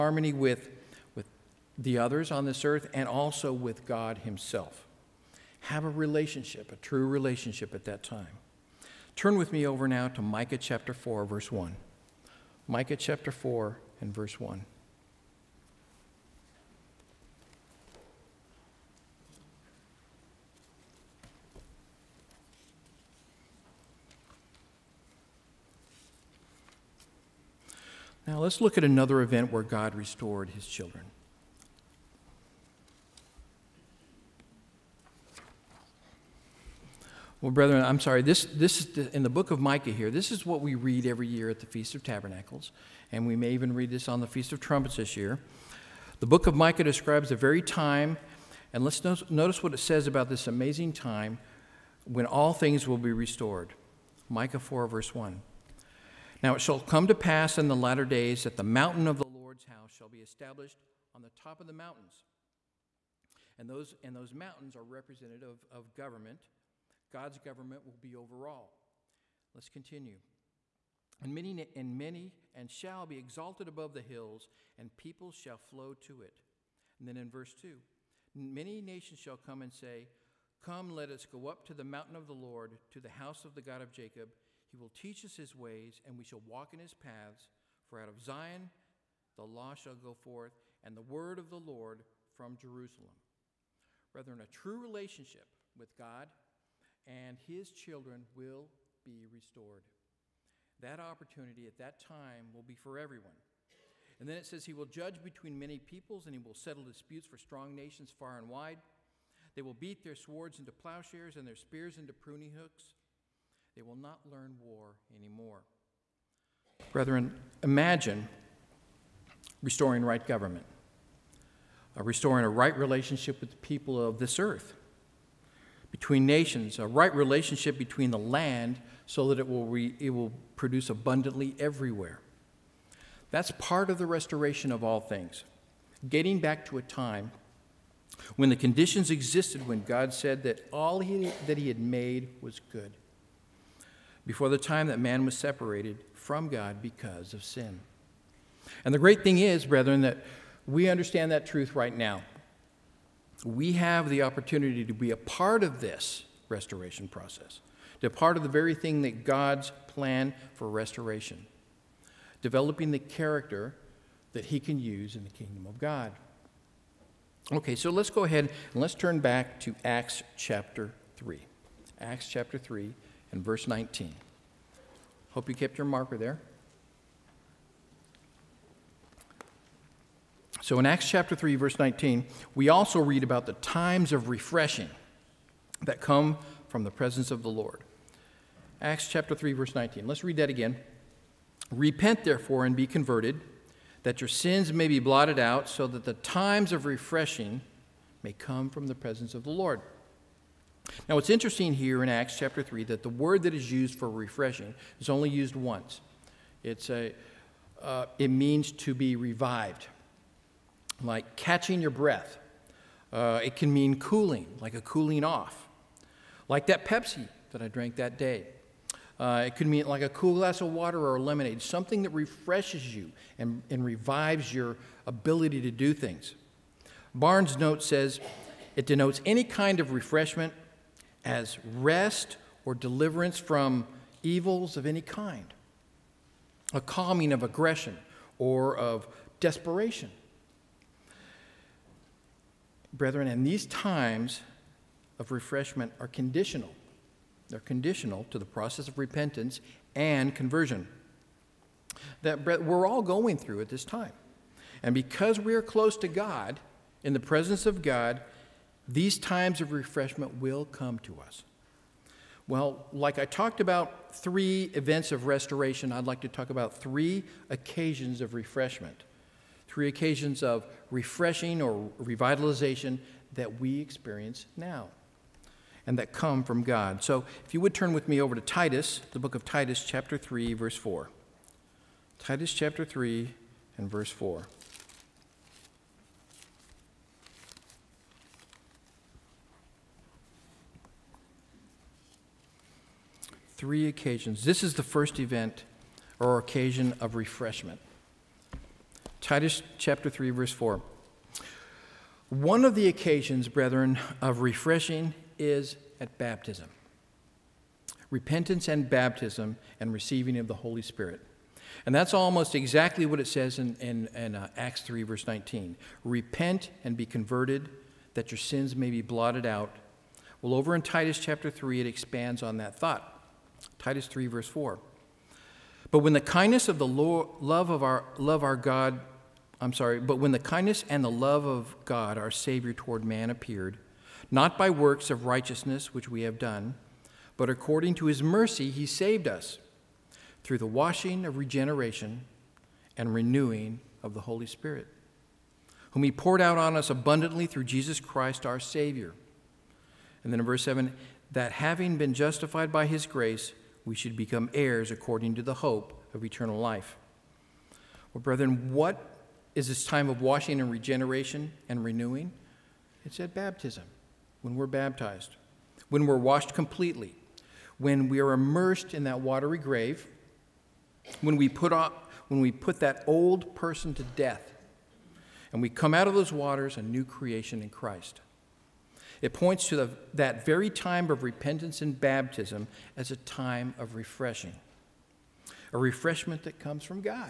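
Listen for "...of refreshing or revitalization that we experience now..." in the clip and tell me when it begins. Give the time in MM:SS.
04:30.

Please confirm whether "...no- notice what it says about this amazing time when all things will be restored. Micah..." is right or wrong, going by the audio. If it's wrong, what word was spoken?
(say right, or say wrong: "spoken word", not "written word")
right.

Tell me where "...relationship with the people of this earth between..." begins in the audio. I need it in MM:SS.
02:02.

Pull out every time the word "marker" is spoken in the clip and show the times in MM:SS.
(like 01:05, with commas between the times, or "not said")
02:55.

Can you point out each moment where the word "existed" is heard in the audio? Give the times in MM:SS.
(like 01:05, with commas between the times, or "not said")
02:19.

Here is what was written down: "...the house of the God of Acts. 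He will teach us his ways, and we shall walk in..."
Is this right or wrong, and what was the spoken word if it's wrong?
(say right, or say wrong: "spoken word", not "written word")
wrong: "Jacob", not "Acts".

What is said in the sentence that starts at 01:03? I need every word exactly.
And those, and those mountains are representative of, of government God's government will be over all.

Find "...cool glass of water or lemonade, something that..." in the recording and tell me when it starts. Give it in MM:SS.
03:40.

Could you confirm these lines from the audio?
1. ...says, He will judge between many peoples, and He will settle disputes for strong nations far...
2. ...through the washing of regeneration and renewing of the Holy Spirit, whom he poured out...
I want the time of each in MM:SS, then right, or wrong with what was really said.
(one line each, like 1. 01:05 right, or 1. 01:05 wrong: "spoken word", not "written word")
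1. 01:44 right
2. 05:40 right.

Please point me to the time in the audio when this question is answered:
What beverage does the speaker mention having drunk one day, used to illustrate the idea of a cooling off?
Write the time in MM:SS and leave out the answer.
03:36.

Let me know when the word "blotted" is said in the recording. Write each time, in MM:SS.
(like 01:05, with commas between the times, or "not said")
03:14, 05:19.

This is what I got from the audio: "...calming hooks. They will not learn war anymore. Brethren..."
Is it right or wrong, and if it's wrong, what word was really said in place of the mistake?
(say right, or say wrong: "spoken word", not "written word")
wrong: "pruning", not "calming".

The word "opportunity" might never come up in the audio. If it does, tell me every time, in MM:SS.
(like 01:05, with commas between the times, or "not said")
01:40, 02:34.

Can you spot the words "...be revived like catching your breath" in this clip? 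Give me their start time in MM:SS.
03:28.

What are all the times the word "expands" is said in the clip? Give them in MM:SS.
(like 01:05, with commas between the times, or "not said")
05:21.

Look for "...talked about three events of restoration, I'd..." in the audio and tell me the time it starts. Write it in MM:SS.
04:23.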